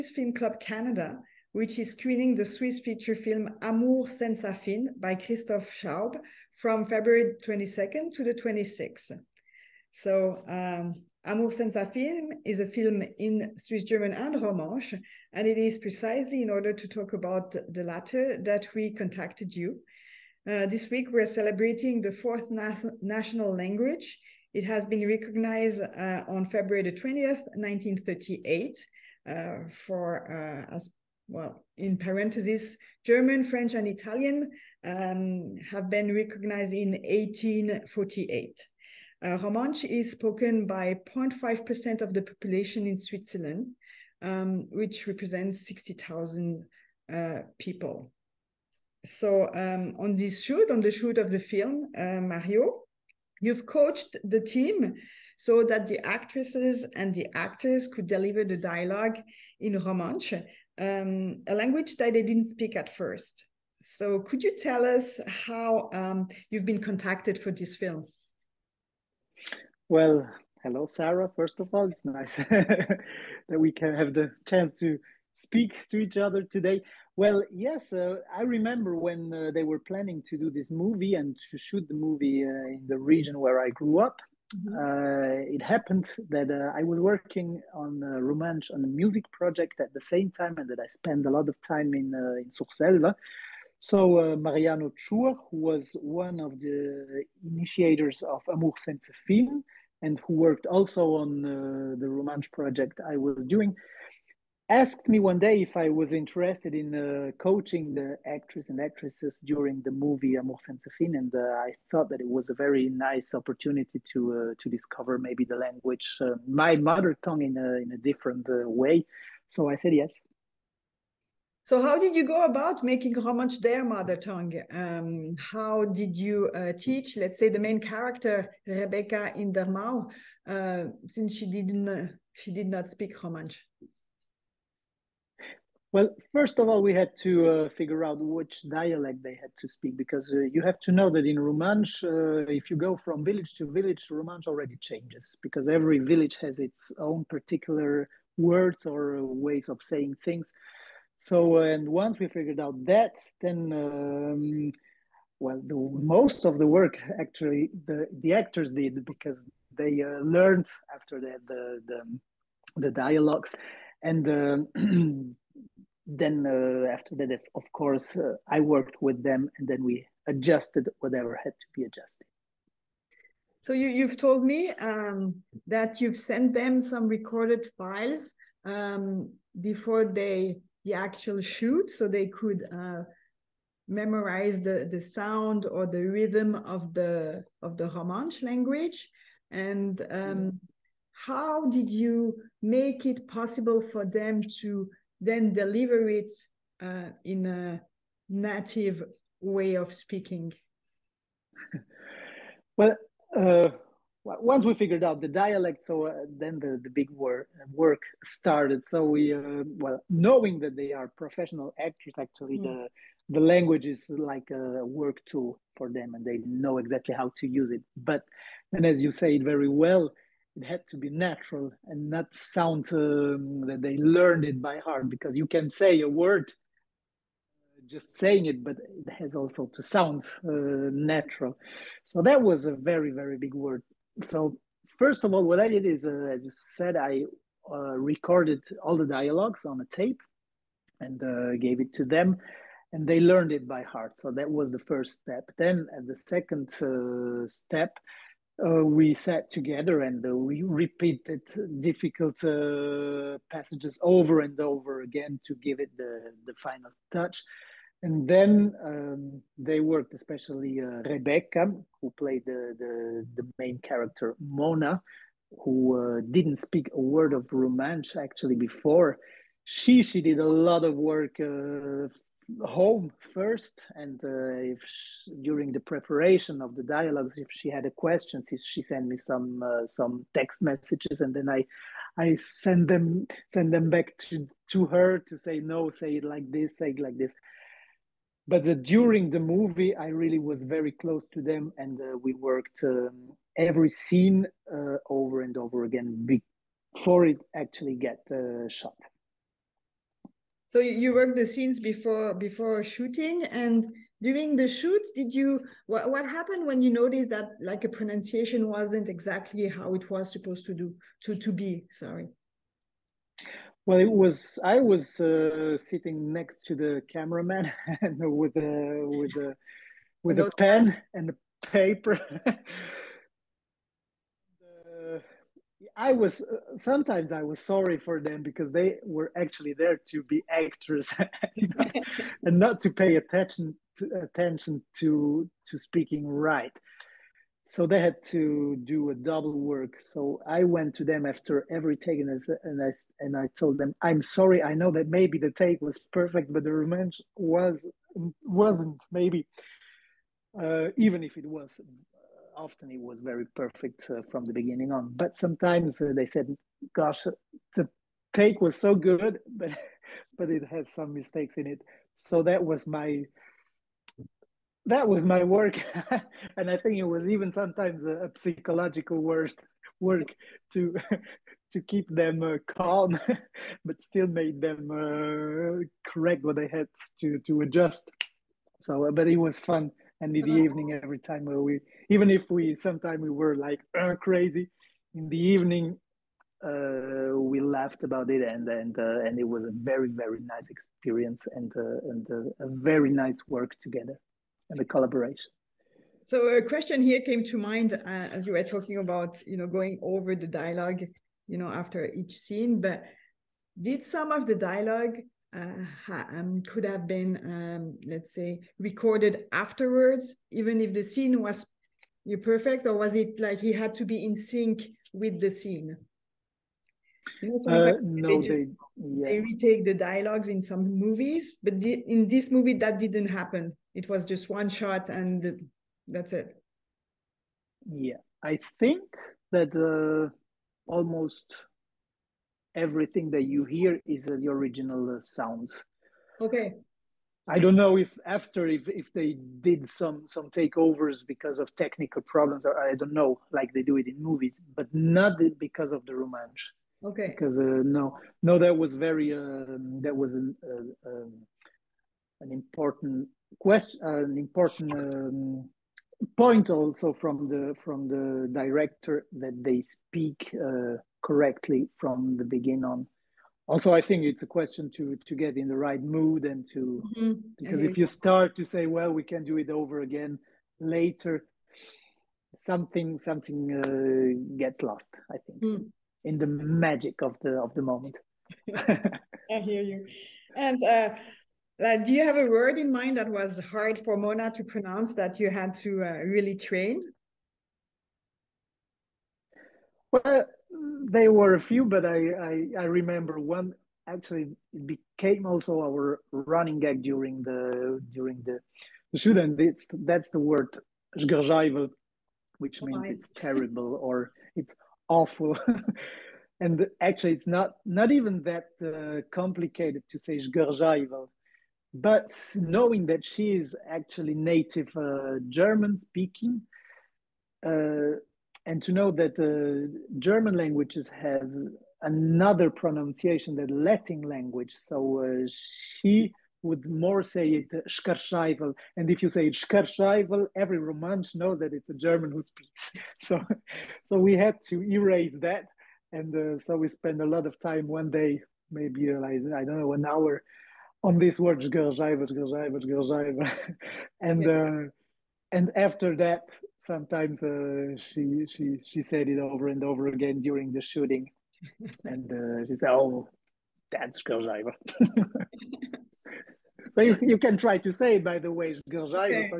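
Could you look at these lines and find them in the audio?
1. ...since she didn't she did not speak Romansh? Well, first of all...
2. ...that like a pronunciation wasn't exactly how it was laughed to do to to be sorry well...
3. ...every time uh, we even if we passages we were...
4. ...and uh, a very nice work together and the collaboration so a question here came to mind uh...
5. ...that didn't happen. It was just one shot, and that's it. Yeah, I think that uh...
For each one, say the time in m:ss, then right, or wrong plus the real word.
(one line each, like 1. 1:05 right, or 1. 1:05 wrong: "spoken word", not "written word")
1. 2:11 right
2. 5:07 wrong: "supposed", not "laughed"
3. 6:21 wrong: "sometimes", not "passages"
4. 6:32 right
5. 7:02 right.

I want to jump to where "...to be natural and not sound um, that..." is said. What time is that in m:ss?
3:40.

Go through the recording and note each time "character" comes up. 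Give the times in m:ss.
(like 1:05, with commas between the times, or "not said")
2:07, 4:23.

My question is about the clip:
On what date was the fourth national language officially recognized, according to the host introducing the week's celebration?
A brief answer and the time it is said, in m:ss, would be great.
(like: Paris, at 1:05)
February 20, 1938, at 0:26.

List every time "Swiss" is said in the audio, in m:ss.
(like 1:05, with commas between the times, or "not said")
0:02, 0:13.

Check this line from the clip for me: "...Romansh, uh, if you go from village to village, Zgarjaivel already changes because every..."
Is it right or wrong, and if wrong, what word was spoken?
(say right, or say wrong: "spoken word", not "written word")
wrong: "Romansh", not "Zgarjaivel".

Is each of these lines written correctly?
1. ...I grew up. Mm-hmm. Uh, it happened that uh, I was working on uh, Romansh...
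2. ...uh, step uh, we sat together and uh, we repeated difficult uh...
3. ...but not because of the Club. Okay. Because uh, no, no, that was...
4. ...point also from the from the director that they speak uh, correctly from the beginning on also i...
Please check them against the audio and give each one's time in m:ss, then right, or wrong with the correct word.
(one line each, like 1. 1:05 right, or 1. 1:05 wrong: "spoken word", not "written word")
1. 1:23 right
2. 4:06 right
3. 7:24 wrong: "Romansh", not "Club"
4. 7:36 right.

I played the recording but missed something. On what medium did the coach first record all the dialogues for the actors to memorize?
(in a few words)
a tape.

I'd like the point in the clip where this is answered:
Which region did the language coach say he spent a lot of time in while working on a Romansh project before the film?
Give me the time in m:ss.
1:32.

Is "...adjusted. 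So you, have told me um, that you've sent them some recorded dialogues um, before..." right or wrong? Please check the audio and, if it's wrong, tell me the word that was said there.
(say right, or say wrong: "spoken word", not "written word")
wrong: "files", not "dialogues".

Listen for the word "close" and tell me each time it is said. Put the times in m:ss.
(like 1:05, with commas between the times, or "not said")
4:50.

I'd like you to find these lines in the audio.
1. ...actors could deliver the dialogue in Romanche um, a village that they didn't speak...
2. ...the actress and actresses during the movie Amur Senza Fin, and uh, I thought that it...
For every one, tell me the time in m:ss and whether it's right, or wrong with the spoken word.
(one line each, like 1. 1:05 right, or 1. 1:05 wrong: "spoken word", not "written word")
1. 0:57 wrong: "language", not "village"
2. 1:47 right.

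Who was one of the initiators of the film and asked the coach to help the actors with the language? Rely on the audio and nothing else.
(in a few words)
Mariano Chur.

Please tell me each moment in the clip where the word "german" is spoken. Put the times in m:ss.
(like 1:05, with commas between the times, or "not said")
0:13, 0:33, 8:35, 8:40, 8:51.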